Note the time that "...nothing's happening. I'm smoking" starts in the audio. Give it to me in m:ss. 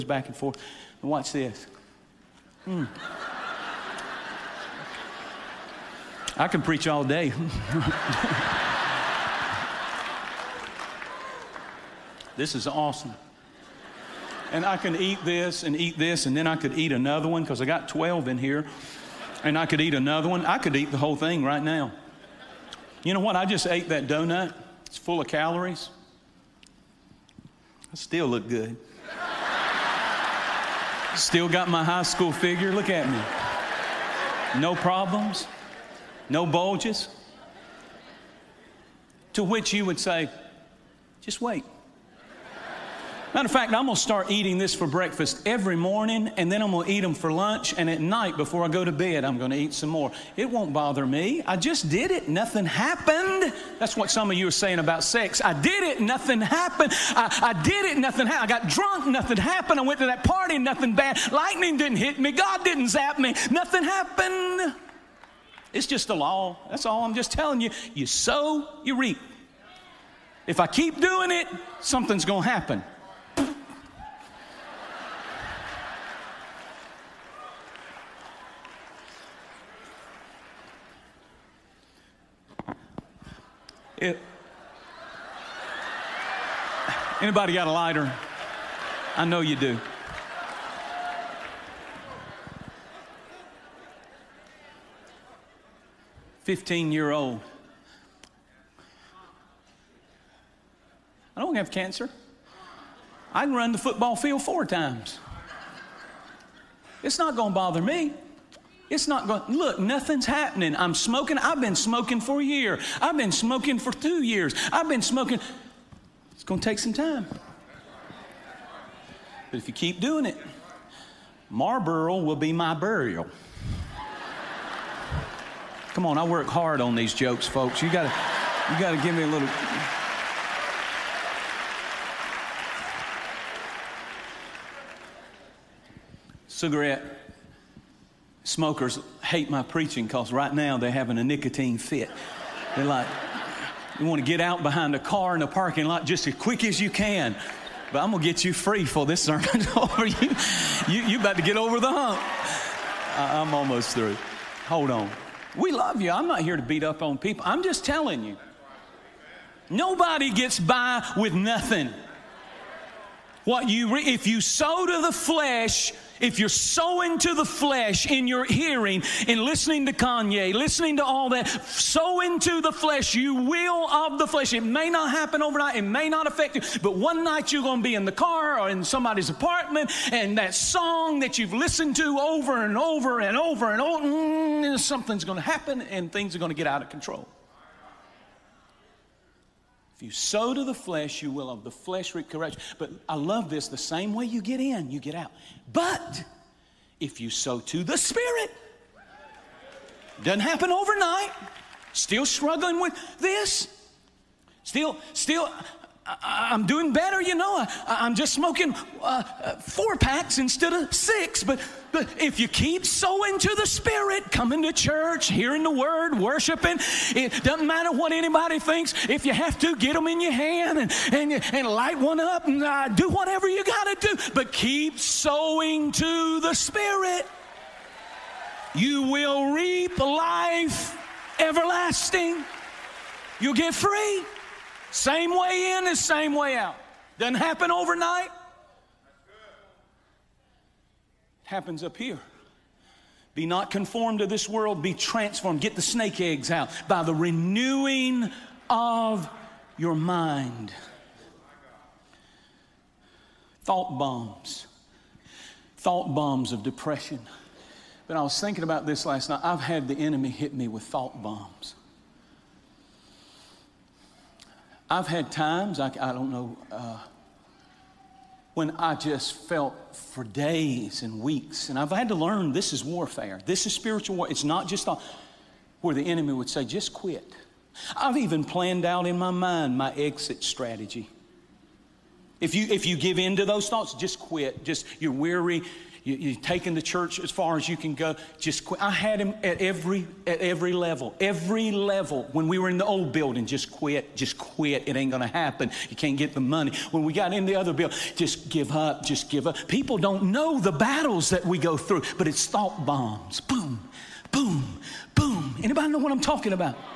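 1:49.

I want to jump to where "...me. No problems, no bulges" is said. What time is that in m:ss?
0:33.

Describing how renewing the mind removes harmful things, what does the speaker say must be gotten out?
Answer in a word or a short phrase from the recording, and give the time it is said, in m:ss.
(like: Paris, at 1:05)
snake eggs, at 4:05.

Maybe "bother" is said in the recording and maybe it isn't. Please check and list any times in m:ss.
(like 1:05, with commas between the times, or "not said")
0:50, 1:47.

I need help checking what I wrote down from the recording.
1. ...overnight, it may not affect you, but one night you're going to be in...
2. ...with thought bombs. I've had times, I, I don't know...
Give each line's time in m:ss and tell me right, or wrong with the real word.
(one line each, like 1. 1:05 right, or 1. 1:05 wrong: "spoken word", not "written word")
1. 2:55 right
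2. 4:20 right.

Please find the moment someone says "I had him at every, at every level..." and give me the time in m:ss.
4:48.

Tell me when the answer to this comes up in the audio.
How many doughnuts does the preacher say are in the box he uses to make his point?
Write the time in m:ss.
0:17.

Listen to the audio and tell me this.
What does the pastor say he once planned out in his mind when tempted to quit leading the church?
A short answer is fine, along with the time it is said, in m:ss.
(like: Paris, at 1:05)
exit strategy, at 4:39.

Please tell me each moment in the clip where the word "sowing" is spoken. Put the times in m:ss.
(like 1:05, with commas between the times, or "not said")
2:46, 3:32, 3:44.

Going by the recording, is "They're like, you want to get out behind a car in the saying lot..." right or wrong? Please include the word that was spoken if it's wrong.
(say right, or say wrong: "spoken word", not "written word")
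wrong: "parking", not "saying".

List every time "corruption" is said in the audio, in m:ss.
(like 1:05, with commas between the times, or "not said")
3:12.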